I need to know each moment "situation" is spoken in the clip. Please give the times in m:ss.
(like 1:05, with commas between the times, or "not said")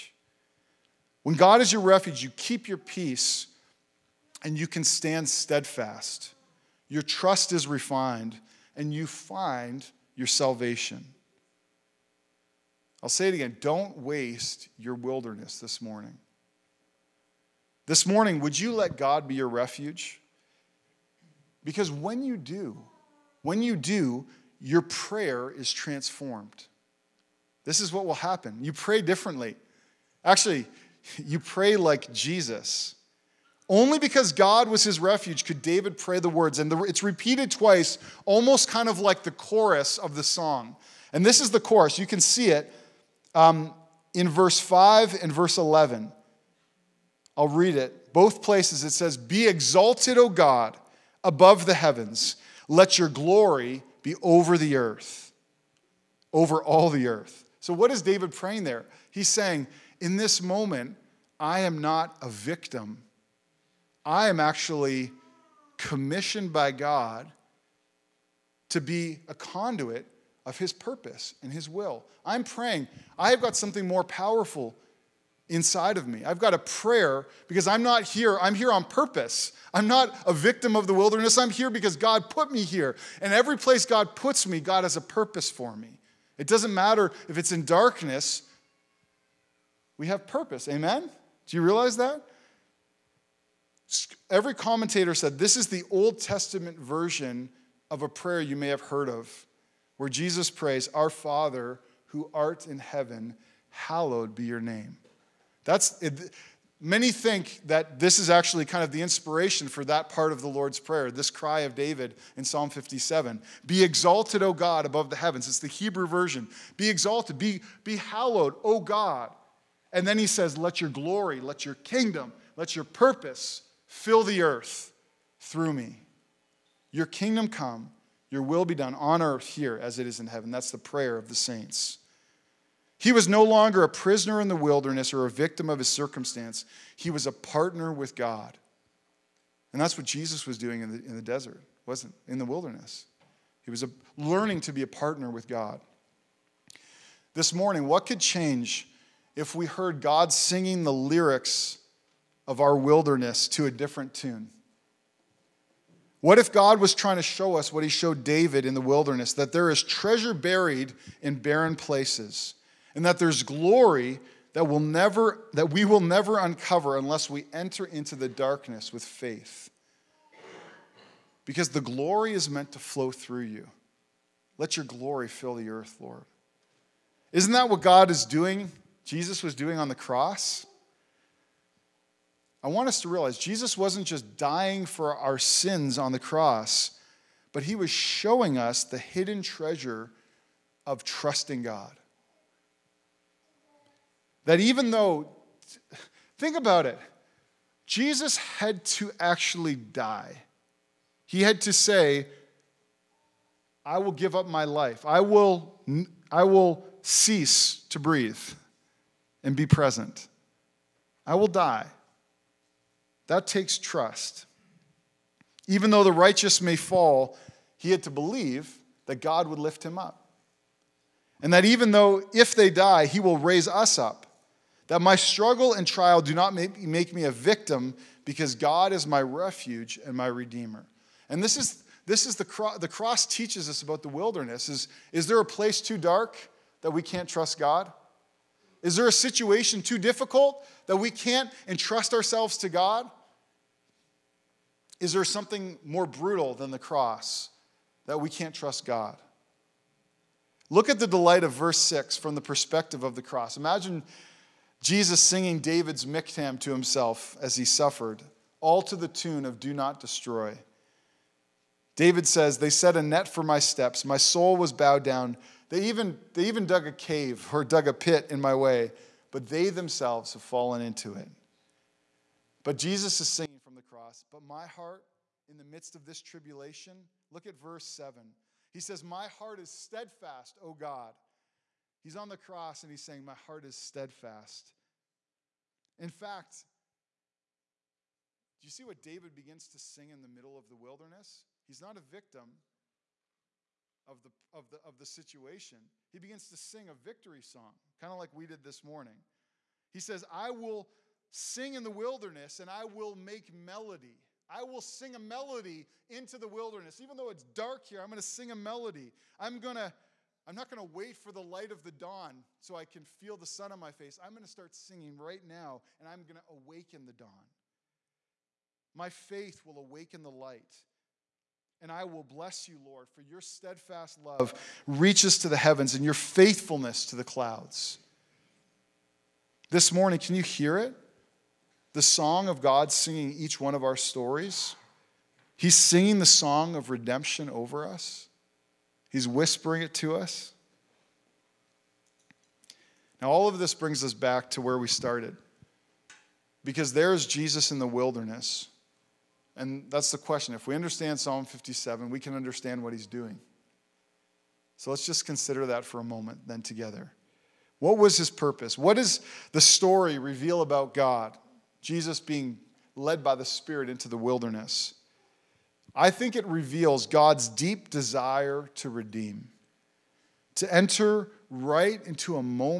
3:59, 4:55.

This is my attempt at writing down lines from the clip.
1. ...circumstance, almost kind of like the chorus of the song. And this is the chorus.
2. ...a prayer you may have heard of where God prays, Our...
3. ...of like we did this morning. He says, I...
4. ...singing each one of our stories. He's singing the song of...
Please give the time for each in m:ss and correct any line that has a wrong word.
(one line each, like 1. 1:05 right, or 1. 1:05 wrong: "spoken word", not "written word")
1. 0:37 wrong: "twice", not "circumstance"
2. 1:38 wrong: "Jesus", not "God"
3. 4:58 right
4. 5:32 right.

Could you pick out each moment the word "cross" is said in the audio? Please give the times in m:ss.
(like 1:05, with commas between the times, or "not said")
2:59, 3:06, 3:52, 4:06, 4:13, 4:33, 4:42.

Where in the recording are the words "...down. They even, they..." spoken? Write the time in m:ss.
4:25.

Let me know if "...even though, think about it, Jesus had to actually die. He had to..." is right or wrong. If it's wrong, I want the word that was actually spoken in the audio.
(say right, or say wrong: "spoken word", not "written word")
right.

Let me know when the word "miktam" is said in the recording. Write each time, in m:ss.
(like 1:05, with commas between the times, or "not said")
4:16.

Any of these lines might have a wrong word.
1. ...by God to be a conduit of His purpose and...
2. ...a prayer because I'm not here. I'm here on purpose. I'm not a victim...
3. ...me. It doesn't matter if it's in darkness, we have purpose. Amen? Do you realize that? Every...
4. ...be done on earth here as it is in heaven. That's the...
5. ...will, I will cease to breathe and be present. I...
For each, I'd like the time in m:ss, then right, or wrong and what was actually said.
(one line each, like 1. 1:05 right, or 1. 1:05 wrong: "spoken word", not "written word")
1. 1:06 right
2. 1:16 right
3. 1:25 right
4. 2:08 right
5. 3:25 right.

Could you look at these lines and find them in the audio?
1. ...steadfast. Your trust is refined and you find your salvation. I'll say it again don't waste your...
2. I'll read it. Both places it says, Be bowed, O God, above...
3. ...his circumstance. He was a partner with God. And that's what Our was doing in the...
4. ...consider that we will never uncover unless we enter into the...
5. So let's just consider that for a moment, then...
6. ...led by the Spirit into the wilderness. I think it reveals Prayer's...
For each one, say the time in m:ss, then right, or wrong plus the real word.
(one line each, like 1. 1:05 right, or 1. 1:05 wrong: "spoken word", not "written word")
1. 0:05 right
2. 0:47 wrong: "exalted", not "bowed"
3. 2:15 wrong: "Jesus", not "Our"
4. 2:44 wrong: "never", not "consider"
5. 5:54 right
6. 6:02 wrong: "God", not "Prayer".